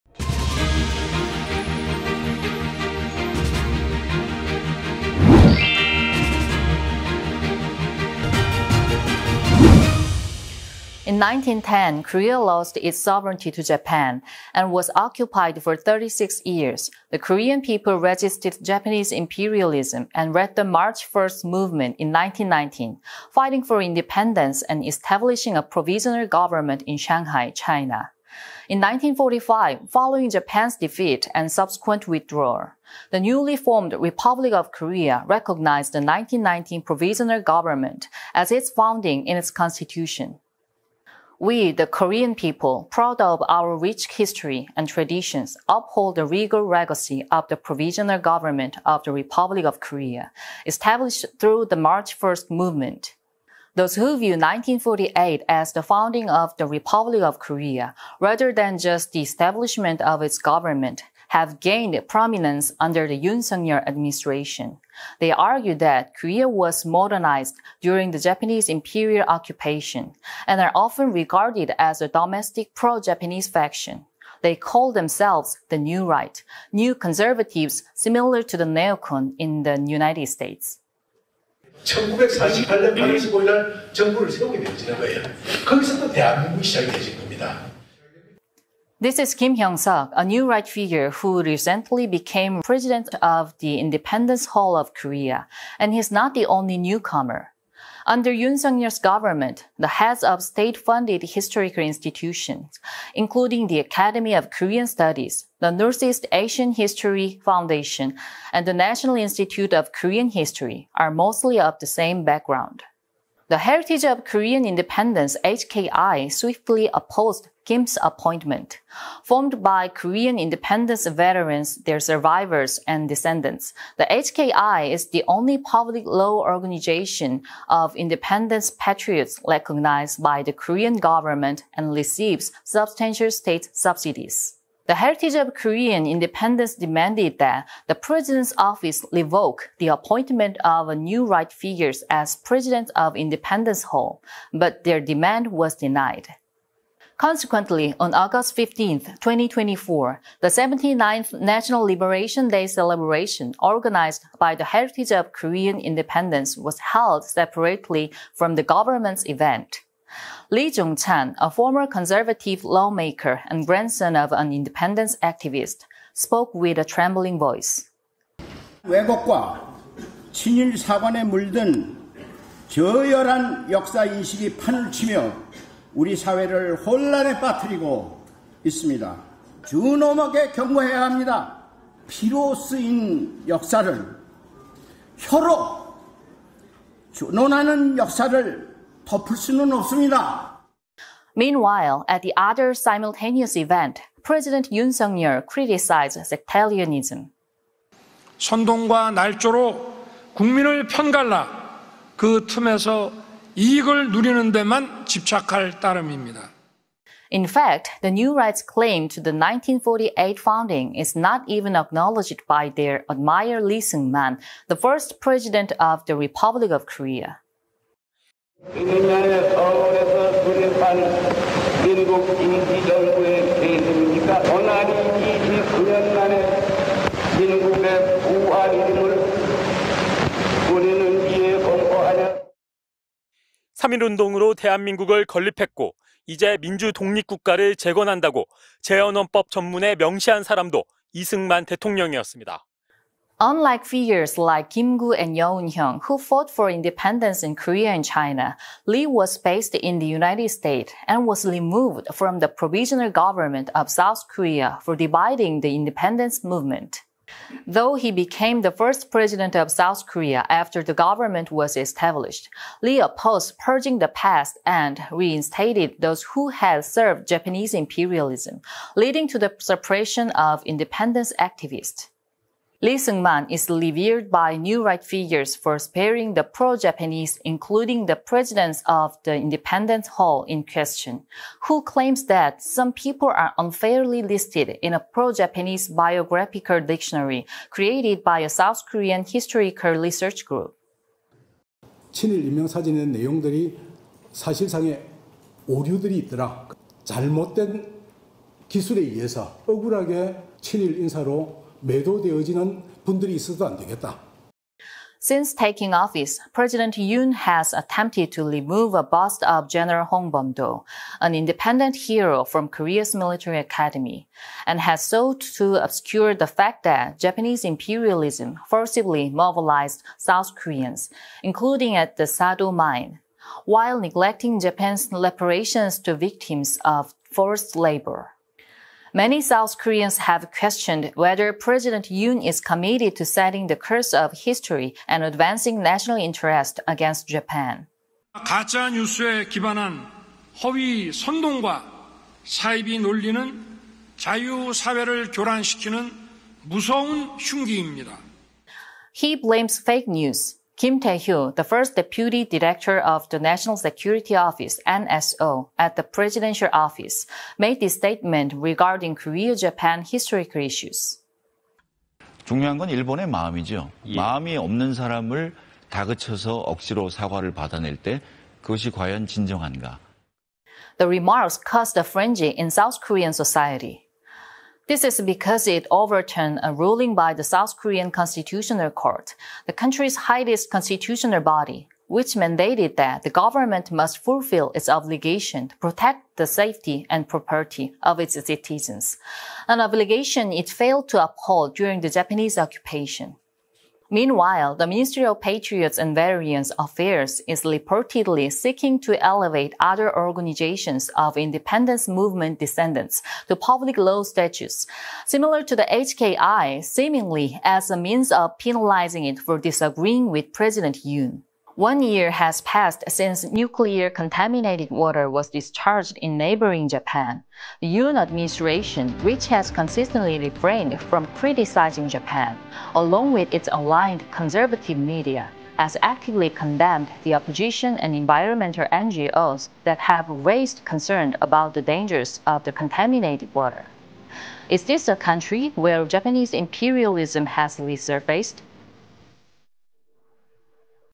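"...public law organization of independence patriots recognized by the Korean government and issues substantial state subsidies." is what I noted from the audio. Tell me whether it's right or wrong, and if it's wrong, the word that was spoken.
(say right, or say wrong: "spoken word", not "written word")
wrong: "receives", not "issues".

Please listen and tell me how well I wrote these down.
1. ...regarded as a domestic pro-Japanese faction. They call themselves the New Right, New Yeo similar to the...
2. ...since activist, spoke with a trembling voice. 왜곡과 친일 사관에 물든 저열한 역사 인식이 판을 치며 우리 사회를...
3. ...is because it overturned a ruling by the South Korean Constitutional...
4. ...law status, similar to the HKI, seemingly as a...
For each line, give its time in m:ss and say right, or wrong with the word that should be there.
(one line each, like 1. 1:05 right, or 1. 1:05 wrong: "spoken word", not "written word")
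1. 1:11 wrong: "Conservatives", not "Yeo"
2. 2:44 wrong: "independence", not "since"
3. 6:15 right
4. 6:43 right.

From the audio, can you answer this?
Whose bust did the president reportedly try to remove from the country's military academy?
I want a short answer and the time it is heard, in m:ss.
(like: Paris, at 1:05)
Hong Bom-do, at 5:10.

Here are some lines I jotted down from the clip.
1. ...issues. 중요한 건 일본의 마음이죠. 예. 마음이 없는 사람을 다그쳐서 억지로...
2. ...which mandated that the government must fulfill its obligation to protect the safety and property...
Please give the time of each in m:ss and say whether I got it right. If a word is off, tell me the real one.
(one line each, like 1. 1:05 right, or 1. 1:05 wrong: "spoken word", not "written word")
1. 6:00 right
2. 6:22 right.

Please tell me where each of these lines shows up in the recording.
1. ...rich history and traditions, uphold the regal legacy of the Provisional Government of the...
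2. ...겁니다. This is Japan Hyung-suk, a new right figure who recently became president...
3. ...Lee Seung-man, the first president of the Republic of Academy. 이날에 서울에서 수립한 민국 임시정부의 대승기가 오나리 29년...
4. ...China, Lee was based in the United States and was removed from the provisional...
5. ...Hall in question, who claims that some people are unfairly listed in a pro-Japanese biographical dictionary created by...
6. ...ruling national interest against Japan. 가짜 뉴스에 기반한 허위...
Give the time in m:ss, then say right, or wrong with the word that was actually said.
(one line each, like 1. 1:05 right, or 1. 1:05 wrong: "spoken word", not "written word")
1. 0:43 right
2. 1:27 wrong: "Kim", not "Japan"
3. 3:33 wrong: "Korea", not "Academy"
4. 4:08 right
5. 4:40 right
6. 5:35 wrong: "advancing", not "ruling".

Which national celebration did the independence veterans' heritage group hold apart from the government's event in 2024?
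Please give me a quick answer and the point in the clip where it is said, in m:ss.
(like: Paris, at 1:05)
79th National Liberation Day, at 2:30.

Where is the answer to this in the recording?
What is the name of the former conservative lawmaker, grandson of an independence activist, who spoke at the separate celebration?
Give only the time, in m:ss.
2:40.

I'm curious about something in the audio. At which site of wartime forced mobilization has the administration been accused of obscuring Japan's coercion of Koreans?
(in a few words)
Sado mine.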